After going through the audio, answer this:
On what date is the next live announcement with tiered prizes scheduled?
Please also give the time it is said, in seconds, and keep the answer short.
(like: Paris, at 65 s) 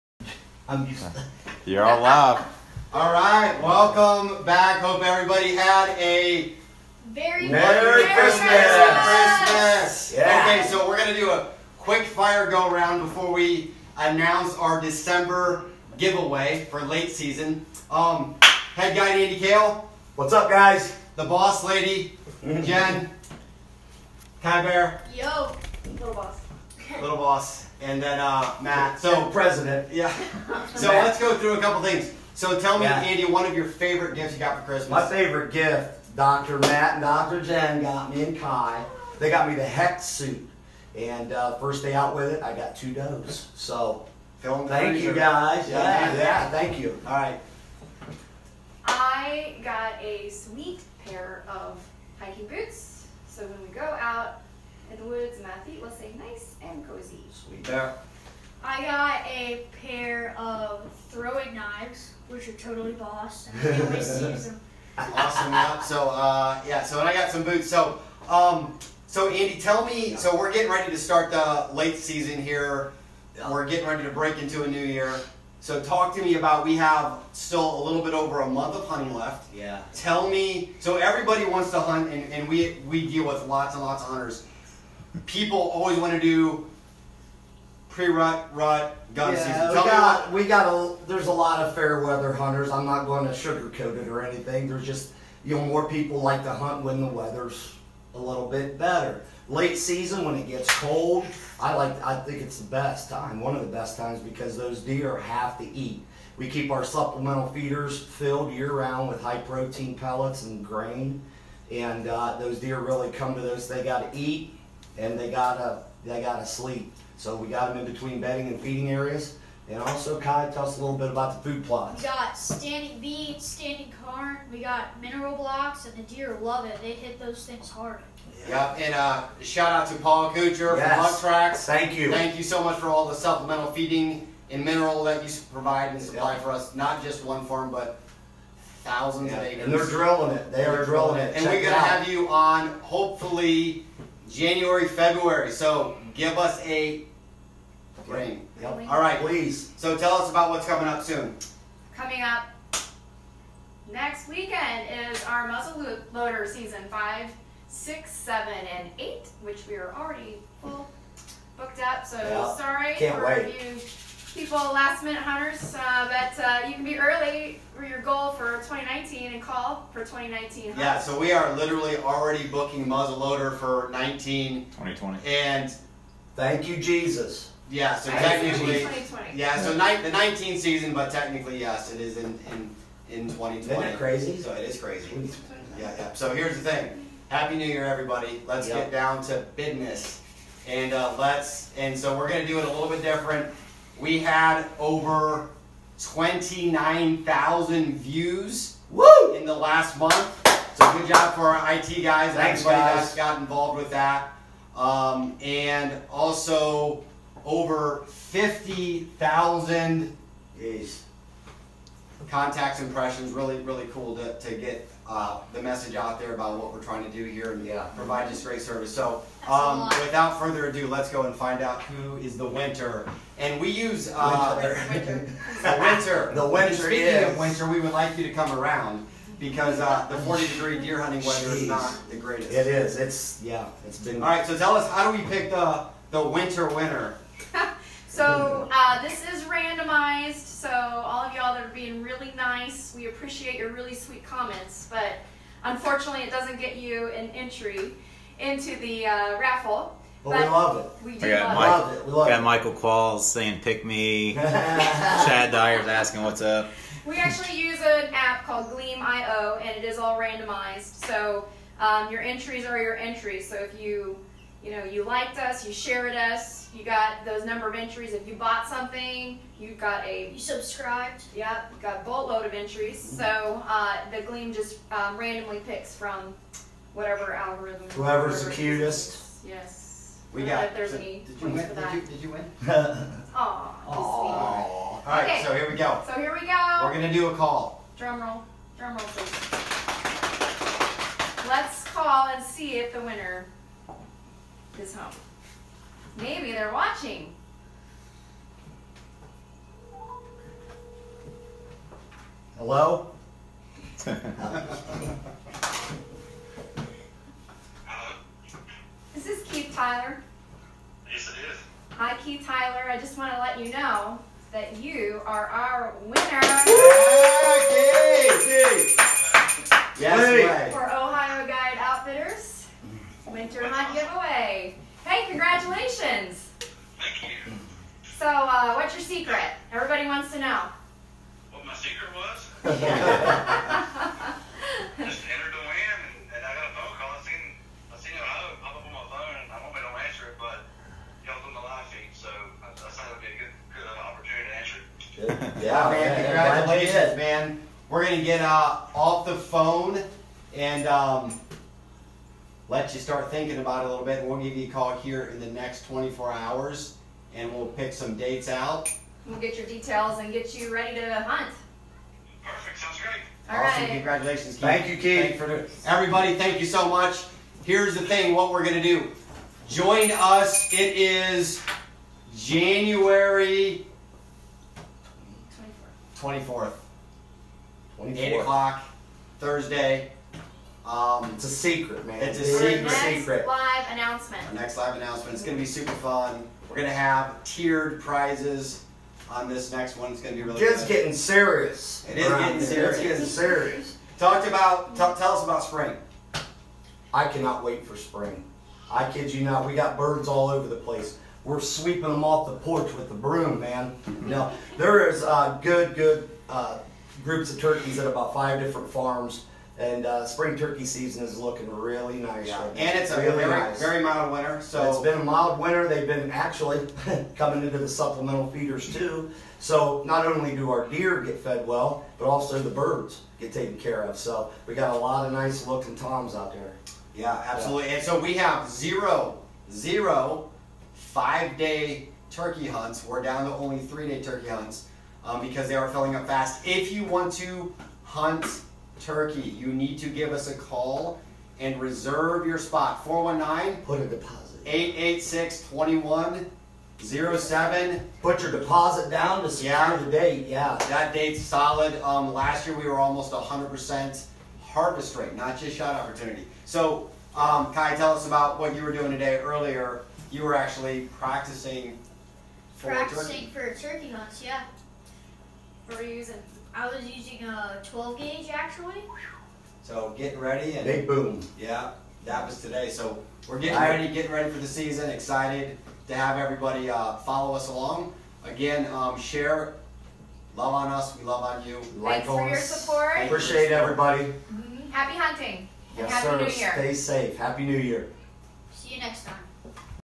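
January 24th, at 372 s.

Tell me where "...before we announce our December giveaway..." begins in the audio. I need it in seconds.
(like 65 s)
13 s.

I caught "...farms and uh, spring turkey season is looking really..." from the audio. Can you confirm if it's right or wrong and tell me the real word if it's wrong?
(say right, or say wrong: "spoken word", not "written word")
right.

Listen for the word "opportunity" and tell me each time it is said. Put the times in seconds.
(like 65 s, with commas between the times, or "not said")
344 s, 455 s.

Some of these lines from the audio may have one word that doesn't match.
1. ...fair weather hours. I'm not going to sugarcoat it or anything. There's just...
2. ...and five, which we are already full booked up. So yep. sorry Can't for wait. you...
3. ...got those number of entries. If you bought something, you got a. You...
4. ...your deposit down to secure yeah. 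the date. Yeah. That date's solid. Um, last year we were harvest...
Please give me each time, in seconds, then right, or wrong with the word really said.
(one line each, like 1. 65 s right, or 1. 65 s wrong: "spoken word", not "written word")
1. 91 s wrong: "hunters", not "hours"
2. 158 s wrong: "eight", not "five"
3. 266 s right
4. 448 s wrong: "almost", not "harvest".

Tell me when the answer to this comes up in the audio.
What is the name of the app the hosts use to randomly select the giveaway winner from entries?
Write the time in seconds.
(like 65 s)
258 s.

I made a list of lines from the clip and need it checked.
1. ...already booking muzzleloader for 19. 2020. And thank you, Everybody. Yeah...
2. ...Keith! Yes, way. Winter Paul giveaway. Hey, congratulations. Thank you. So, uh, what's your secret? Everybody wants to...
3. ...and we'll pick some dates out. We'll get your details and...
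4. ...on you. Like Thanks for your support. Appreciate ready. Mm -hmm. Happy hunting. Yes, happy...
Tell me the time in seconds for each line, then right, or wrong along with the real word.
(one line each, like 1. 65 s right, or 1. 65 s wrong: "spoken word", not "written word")
1. 171 s wrong: "Jesus", not "Everybody"
2. 318 s wrong: "Hunt", not "Paul"
3. 357 s right
4. 481 s wrong: "everybody", not "ready".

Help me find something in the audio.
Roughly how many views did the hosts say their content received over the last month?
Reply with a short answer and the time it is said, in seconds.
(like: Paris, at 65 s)
29,000, at 195 s.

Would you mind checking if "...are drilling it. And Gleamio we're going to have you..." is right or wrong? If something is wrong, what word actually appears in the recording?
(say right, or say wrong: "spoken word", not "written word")
wrong: "Check", not "Gleamio".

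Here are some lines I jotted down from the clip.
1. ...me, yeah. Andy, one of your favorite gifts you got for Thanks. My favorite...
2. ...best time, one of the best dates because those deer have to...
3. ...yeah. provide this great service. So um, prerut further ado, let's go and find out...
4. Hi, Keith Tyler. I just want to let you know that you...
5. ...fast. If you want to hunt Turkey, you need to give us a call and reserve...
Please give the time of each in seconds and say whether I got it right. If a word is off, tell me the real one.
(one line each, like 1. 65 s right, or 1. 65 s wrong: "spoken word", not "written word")
1. 32 s wrong: "Christmas", not "Thanks"
2. 102 s wrong: "times", not "dates"
3. 217 s wrong: "without", not "prerut"
4. 311 s right
5. 436 s right.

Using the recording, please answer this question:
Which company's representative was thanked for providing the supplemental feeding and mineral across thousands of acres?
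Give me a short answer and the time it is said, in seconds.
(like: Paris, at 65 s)
Hunt Tracks, at 131 s.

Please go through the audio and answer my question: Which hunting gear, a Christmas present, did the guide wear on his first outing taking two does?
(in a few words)
HECS suit.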